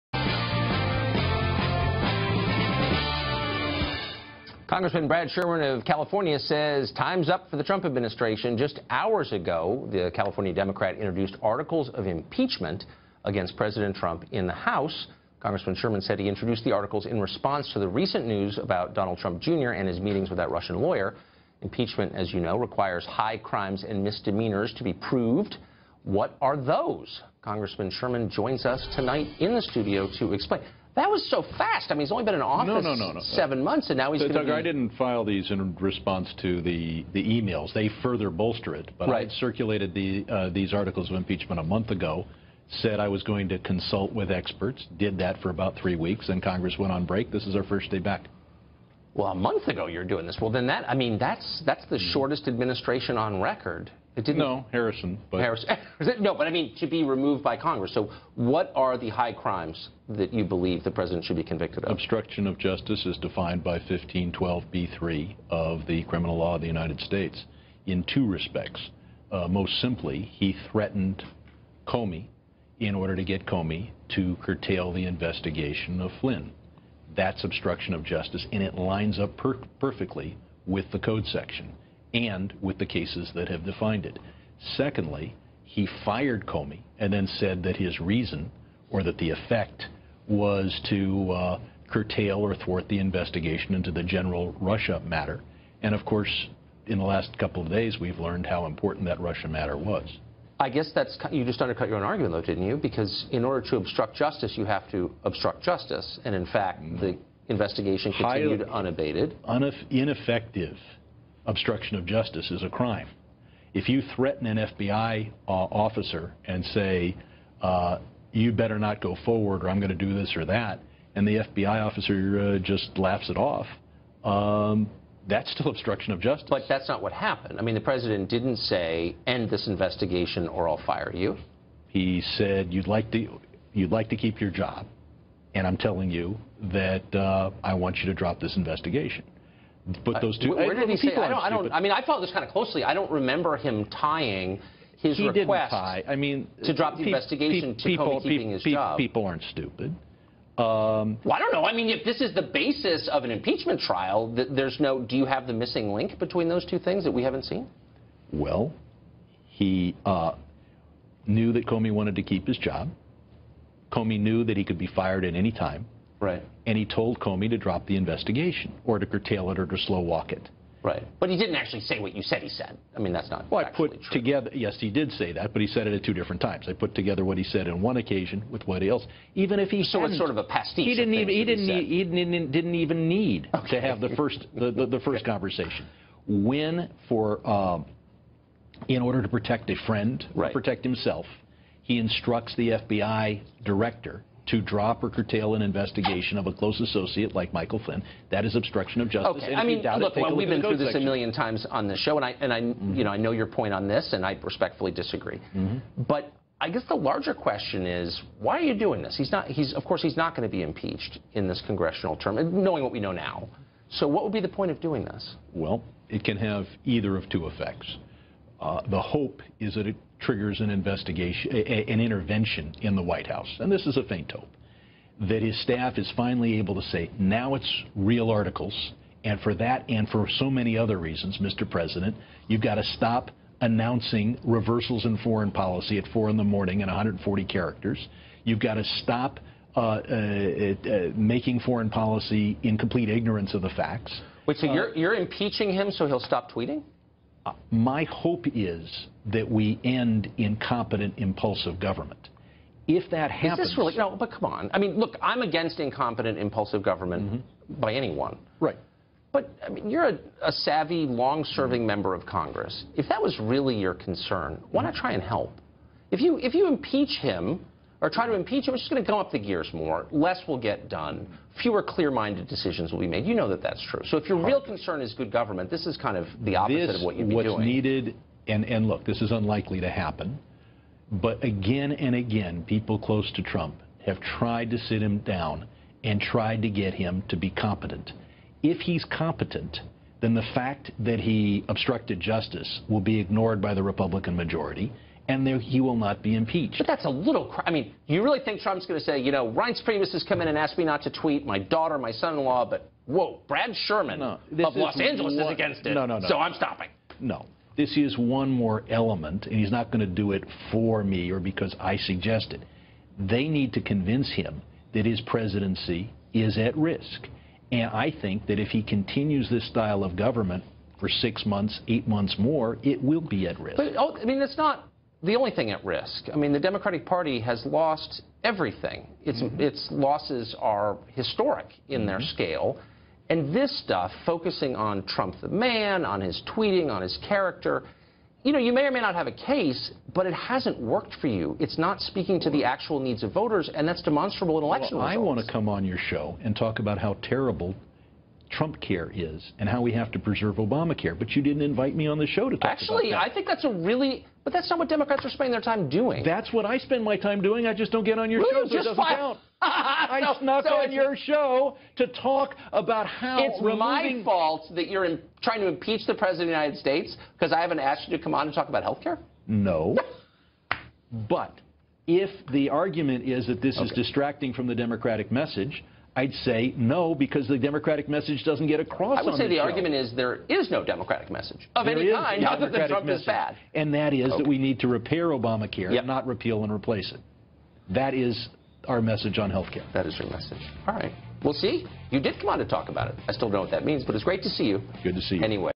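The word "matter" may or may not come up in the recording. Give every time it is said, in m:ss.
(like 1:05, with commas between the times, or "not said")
1:35, 1:39.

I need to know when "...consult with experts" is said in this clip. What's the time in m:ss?
0:43.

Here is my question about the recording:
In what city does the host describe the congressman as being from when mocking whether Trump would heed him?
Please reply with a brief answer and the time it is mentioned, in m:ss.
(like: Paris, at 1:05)
Los Angeles, at 5:04.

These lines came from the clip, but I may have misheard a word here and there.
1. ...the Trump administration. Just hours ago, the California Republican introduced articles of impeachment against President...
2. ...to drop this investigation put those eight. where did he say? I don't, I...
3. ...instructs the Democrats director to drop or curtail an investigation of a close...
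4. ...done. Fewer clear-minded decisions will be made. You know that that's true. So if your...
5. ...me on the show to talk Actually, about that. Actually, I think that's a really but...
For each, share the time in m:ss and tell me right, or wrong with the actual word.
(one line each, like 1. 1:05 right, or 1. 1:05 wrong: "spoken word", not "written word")
1. 0:07 wrong: "Democrat", not "Republican"
2. 2:18 wrong: "two", not "eight"
3. 3:11 wrong: "FBI", not "Democrats"
4. 4:30 right
5. 5:52 right.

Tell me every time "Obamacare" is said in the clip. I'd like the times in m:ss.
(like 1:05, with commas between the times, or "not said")
5:50, 6:25.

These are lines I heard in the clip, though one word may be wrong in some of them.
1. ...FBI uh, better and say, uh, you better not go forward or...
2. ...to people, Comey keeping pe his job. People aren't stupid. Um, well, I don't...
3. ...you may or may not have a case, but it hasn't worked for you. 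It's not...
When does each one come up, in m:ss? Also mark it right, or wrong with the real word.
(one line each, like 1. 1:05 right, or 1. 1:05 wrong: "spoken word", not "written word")
1. 1:54 wrong: "officer", not "better"
2. 2:27 right
3. 5:38 right.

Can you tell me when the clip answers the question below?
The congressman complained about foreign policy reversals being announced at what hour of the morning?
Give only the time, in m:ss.
3:56.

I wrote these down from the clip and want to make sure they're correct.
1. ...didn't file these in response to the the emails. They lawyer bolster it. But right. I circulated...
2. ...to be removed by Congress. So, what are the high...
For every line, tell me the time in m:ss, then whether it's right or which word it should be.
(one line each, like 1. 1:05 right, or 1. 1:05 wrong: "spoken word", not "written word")
1. 0:34 wrong: "further", not "lawyer"
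2. 0:56 right.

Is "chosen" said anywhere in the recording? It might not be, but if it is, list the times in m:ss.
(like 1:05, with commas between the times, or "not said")
not said.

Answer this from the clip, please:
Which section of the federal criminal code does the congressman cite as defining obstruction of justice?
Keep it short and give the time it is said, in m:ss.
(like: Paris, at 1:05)
1512b3, at 1:03.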